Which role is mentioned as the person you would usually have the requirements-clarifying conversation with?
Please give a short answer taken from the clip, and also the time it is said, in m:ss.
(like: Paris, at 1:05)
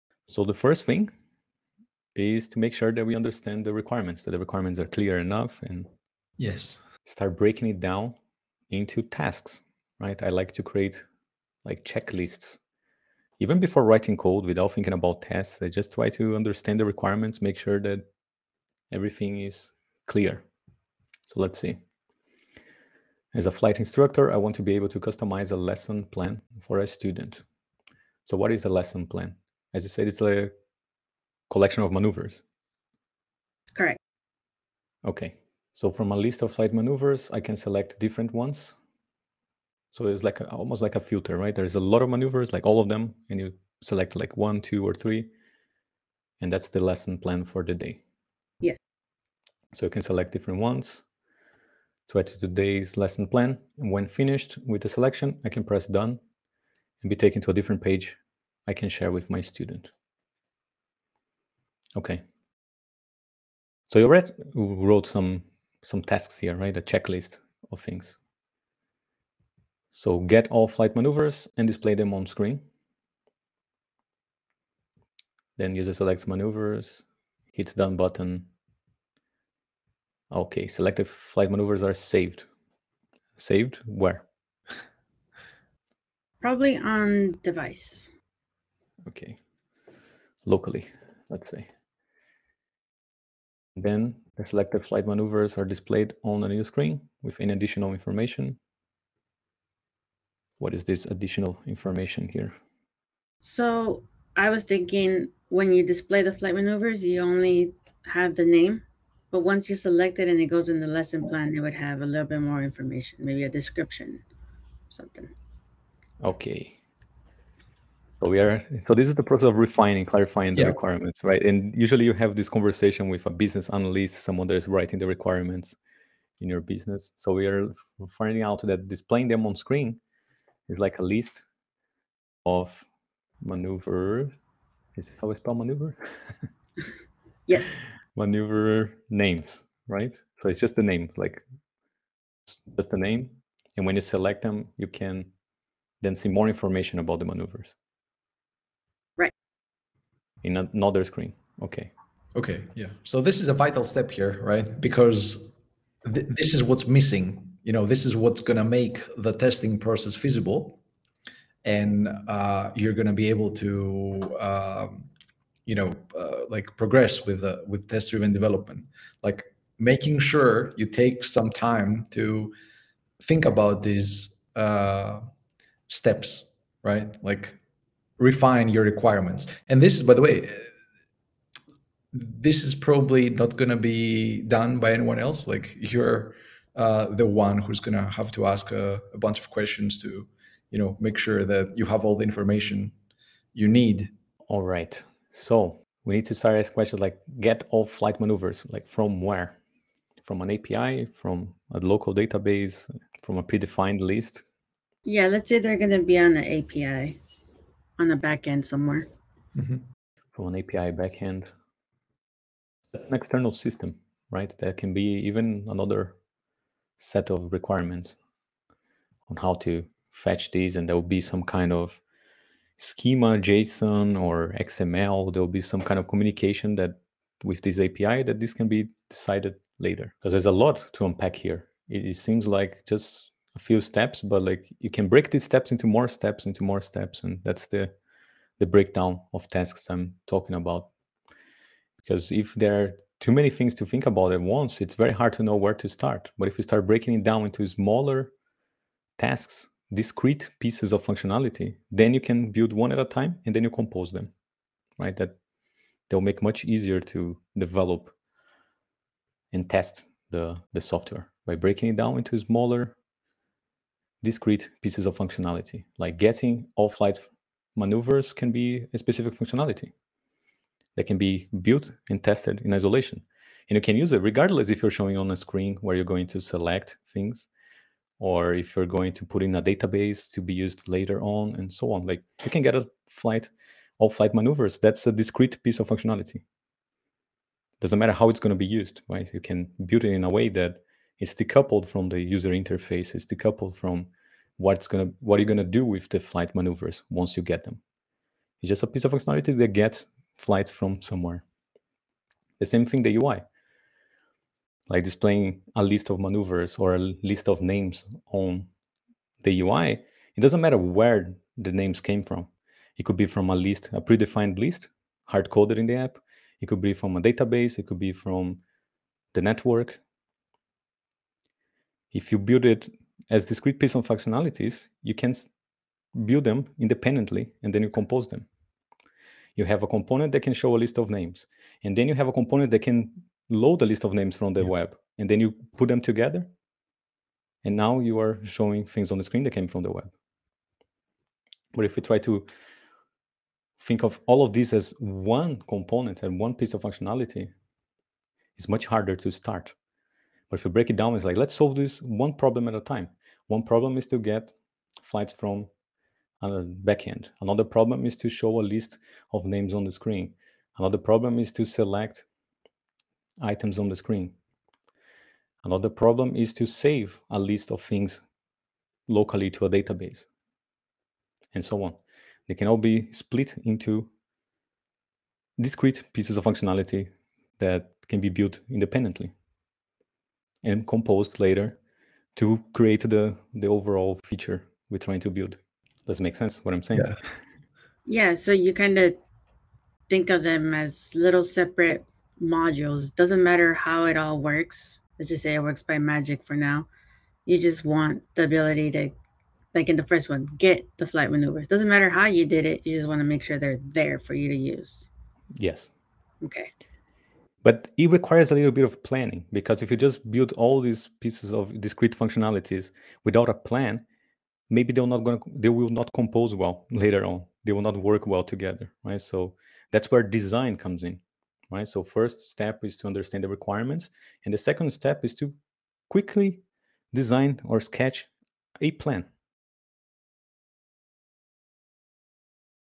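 Business analyst, at 2:03.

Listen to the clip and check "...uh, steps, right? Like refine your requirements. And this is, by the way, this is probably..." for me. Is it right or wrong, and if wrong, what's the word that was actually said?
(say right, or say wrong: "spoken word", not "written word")
right.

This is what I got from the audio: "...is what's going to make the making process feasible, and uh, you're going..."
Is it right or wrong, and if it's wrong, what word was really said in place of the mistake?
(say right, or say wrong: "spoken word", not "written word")
wrong: "testing", not "making".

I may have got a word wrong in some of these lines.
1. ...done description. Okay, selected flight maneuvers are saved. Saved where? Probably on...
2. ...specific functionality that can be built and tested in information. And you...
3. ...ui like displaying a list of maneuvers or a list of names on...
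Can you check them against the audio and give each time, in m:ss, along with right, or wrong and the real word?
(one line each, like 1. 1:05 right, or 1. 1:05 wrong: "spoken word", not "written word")
1. 1:17 wrong: "button", not "description"
2. 4:28 wrong: "isolation", not "information"
3. 5:03 right.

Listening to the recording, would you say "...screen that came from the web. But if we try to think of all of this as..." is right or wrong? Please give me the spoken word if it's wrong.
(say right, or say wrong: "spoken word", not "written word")
right.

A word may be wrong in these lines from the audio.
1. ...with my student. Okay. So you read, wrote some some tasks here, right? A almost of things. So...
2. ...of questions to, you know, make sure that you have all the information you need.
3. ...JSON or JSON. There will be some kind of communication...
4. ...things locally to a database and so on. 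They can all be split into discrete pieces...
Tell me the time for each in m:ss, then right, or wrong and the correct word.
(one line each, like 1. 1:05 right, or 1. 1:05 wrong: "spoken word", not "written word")
1. 0:59 wrong: "checklist", not "almost"
2. 3:09 right
3. 3:43 wrong: "XML", not "JSON"
4. 6:07 right.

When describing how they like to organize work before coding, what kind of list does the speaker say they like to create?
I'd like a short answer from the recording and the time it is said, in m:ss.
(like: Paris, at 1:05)
Checklists, at 0:11.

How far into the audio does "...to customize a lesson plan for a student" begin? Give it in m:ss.
0:24.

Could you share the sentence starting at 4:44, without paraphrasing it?
That's a discrete piece of functionality.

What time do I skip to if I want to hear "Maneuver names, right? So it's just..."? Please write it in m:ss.
2:18.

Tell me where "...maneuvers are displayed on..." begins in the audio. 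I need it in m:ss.
1:35.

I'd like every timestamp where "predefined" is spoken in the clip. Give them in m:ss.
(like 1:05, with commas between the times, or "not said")
3:23, 5:14.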